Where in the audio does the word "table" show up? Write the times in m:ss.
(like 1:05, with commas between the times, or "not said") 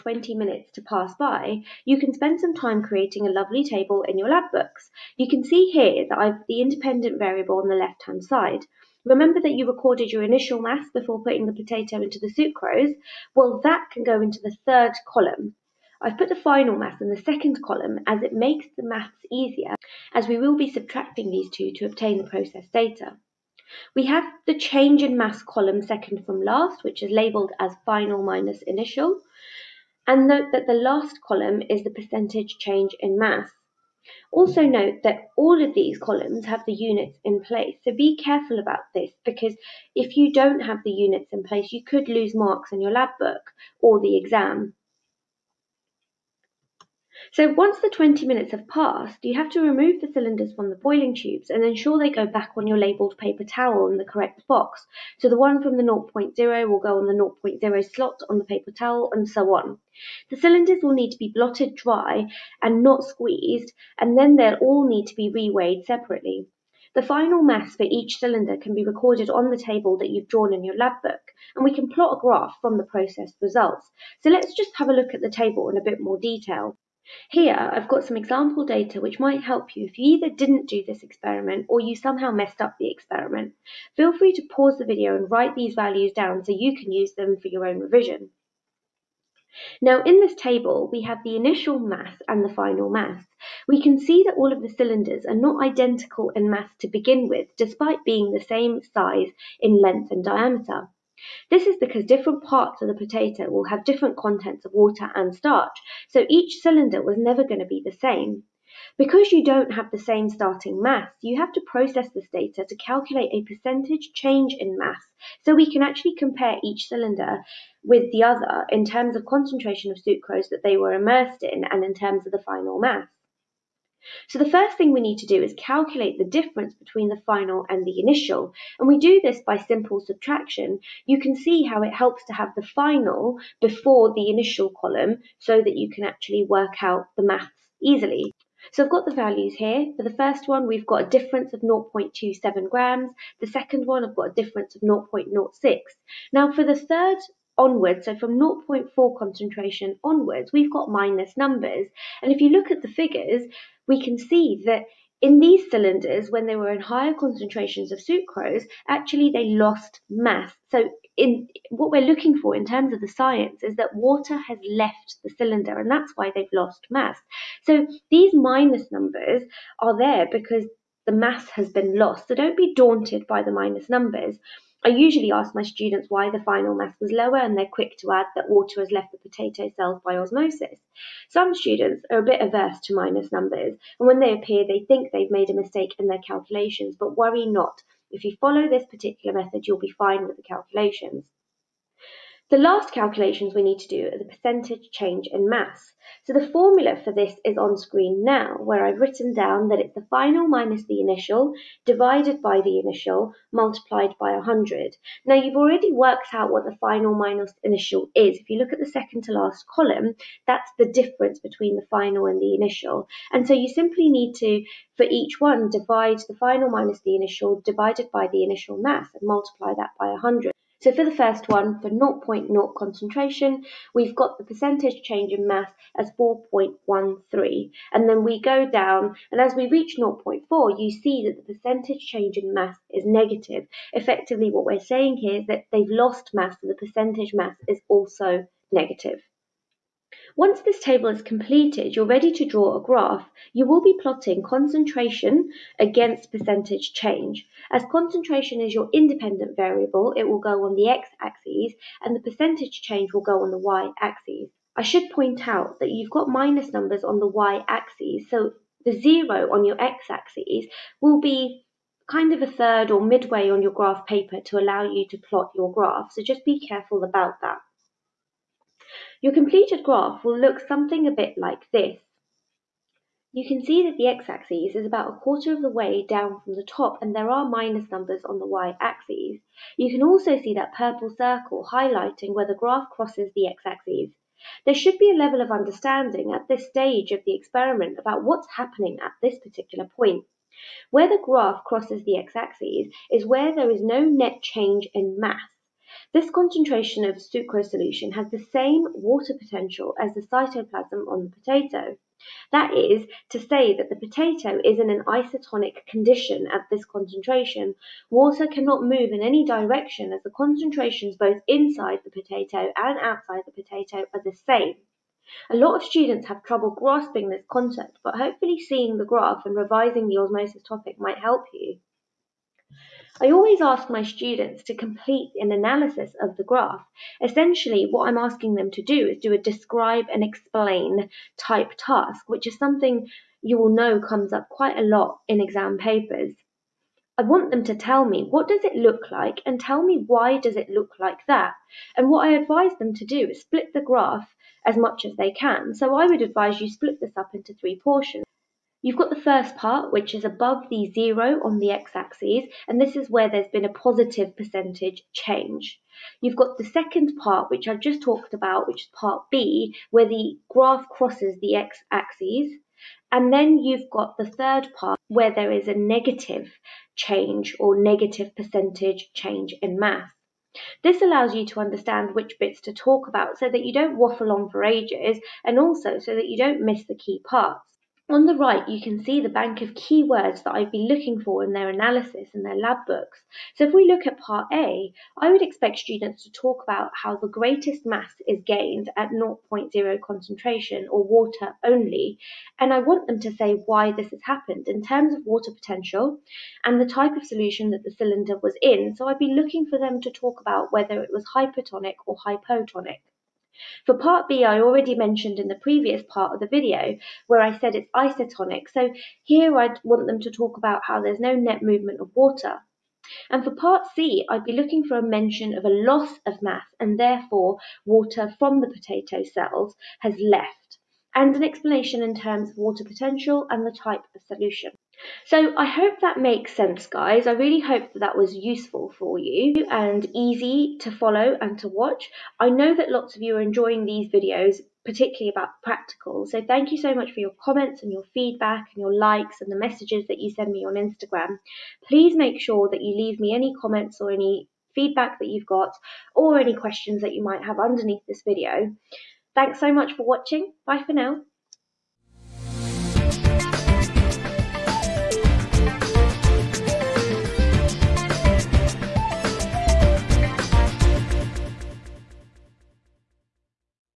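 0:03, 1:09, 1:15, 1:30, 4:00.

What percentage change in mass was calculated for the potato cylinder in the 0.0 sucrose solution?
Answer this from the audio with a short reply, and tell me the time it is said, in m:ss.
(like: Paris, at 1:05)
4.13, at 3:46.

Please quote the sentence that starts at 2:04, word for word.
So the first thing we need to do is calculate the difference between the final and the initial.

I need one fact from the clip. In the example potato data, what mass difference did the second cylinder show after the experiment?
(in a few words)
0.06.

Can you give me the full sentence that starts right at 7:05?
So I hope that makes sense, guys.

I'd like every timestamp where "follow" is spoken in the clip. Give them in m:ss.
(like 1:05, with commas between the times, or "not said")
3:08, 7:10.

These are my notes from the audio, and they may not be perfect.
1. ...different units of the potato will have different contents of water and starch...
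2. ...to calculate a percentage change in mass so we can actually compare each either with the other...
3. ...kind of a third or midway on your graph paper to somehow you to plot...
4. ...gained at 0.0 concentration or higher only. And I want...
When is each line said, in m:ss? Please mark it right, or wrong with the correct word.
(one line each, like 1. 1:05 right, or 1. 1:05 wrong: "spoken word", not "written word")
1. 1:42 wrong: "parts", not "units"
2. 1:52 wrong: "cylinder", not "either"
3. 4:22 wrong: "allow", not "somehow"
4. 6:28 wrong: "water", not "higher".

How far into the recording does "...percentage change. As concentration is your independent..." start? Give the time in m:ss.
4:06.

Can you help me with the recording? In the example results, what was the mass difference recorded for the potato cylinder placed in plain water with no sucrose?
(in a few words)
0.27 grams.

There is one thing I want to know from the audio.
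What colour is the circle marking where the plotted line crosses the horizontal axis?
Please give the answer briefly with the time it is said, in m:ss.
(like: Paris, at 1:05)
purple, at 4:40.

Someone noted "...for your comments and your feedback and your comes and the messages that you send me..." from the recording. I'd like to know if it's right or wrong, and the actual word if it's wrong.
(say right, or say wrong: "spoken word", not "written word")
wrong: "likes", not "comes".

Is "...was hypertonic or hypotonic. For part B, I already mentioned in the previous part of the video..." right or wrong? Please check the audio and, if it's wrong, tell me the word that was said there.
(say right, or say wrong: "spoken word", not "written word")
right.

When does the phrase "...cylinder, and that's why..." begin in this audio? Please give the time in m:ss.
2:45.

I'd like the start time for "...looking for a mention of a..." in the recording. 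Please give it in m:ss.
6:54.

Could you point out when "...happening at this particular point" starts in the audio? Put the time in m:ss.
4:48.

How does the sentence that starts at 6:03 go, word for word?
And then you've got the third part, where there is a negative change or negative percentage change in mass.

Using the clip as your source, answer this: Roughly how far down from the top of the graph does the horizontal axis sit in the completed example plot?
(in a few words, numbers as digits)
a quarter.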